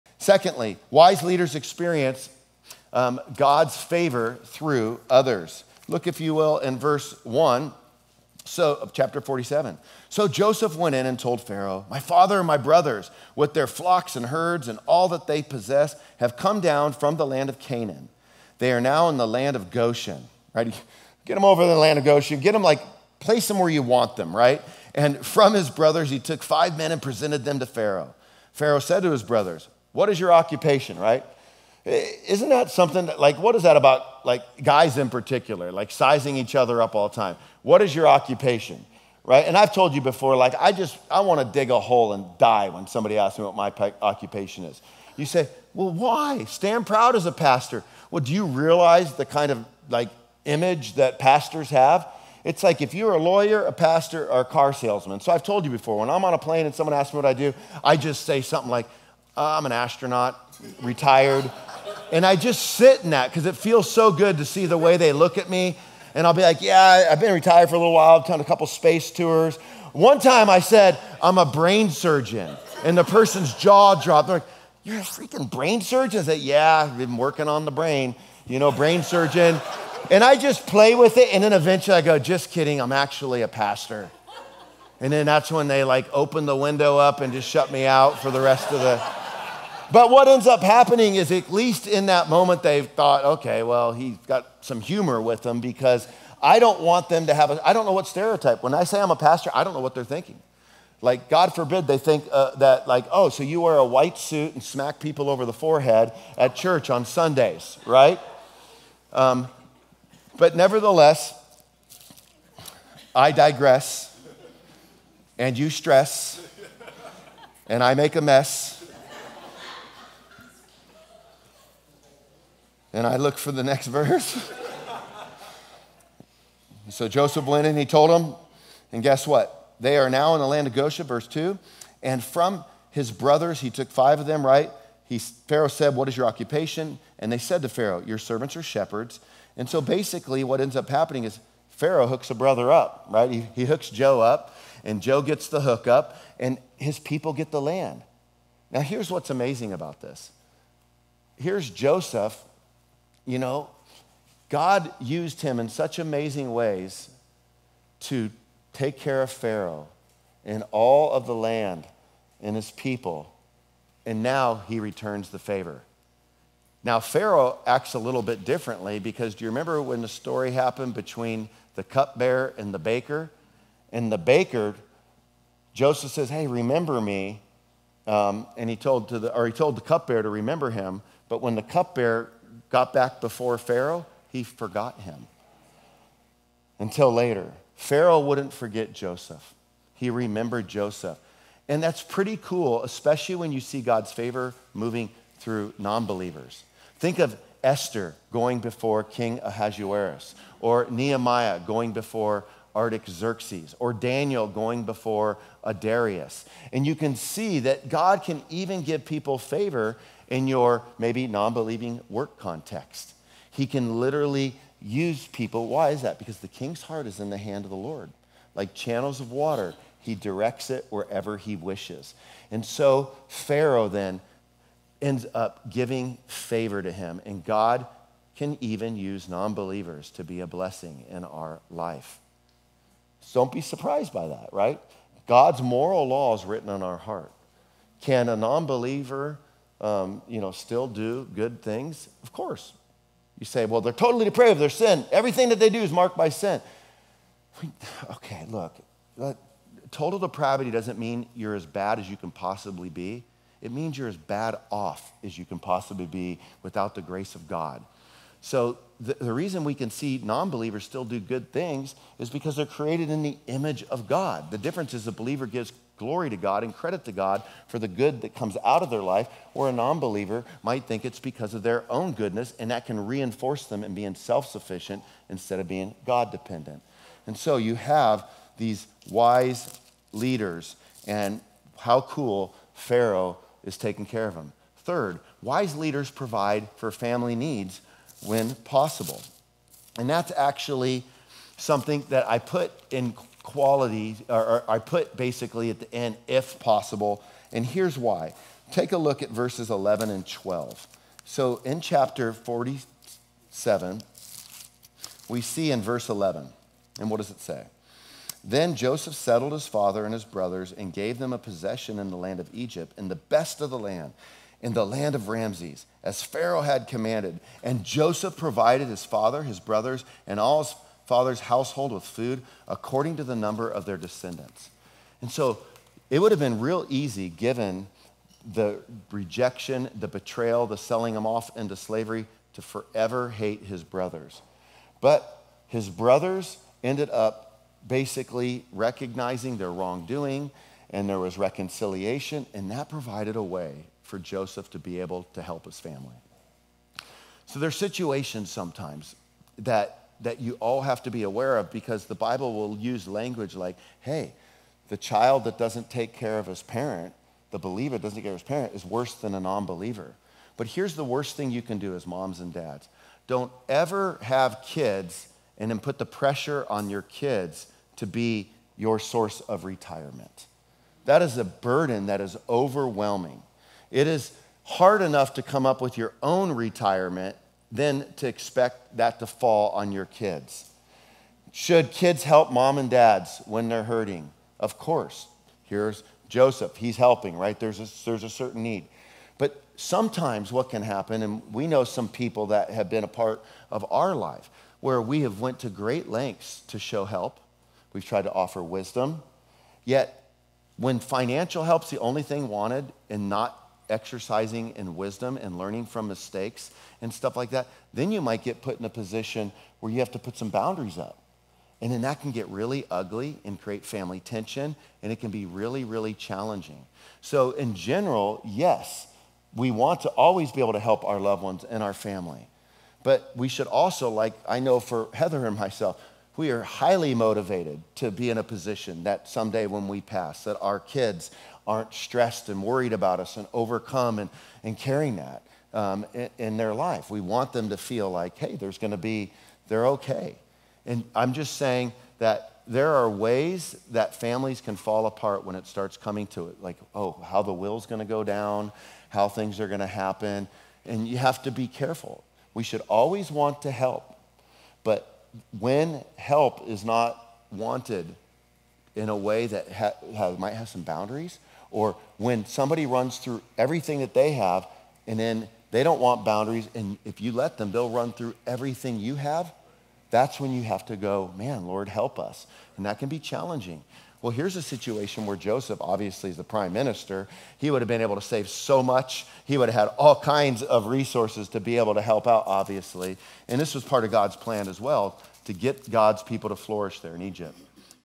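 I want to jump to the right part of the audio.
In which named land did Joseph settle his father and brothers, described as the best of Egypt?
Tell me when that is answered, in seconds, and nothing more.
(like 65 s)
314 s.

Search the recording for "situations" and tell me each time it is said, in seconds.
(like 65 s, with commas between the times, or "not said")
347 s, 474 s.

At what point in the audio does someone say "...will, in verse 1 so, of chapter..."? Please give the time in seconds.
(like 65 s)
6 s.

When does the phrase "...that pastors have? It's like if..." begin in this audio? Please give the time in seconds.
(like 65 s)
50 s.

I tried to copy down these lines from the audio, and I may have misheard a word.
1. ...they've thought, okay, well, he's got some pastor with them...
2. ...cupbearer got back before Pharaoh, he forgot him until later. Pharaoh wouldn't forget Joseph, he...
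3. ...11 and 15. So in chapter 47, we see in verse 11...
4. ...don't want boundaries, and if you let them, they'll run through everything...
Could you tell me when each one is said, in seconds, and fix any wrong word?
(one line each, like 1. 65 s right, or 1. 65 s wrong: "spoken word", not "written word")
1. 92 s wrong: "humor", not "pastor"
2. 181 s right
3. 299 s wrong: "12", not "15"
4. 465 s right.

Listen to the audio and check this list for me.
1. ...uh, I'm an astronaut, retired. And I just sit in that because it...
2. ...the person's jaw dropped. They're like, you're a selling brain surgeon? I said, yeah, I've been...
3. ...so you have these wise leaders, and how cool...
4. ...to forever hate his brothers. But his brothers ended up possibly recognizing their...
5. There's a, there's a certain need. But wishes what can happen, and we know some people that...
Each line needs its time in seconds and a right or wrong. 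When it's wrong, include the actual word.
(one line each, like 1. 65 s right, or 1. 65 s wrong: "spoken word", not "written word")
1. 59 s right
2. 72 s wrong: "freaking", not "selling"
3. 277 s right
4. 332 s wrong: "basically", not "possibly"
5. 387 s wrong: "sometimes", not "wishes".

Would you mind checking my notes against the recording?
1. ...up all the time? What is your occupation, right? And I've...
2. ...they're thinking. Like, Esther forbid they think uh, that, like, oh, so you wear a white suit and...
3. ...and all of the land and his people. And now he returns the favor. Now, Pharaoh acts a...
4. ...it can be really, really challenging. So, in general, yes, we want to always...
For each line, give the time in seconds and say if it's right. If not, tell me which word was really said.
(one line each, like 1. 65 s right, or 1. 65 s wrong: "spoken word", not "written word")
1. 36 s right
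2. 99 s wrong: "God", not "Esther"
3. 160 s right
4. 415 s right.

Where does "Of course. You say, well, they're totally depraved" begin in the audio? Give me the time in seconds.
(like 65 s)
242 s.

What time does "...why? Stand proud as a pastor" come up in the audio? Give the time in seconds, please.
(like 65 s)
45 s.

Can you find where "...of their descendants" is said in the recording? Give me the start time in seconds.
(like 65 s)
323 s.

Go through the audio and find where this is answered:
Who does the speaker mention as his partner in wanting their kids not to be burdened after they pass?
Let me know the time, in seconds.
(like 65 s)
425 s.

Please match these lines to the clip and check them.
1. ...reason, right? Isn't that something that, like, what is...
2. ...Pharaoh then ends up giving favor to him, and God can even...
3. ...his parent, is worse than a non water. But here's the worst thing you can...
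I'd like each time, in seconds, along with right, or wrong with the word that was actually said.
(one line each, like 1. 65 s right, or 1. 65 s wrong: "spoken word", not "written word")
1. 30 s wrong: "occupation", not "reason"
2. 223 s right
3. 358 s wrong: "believer", not "water".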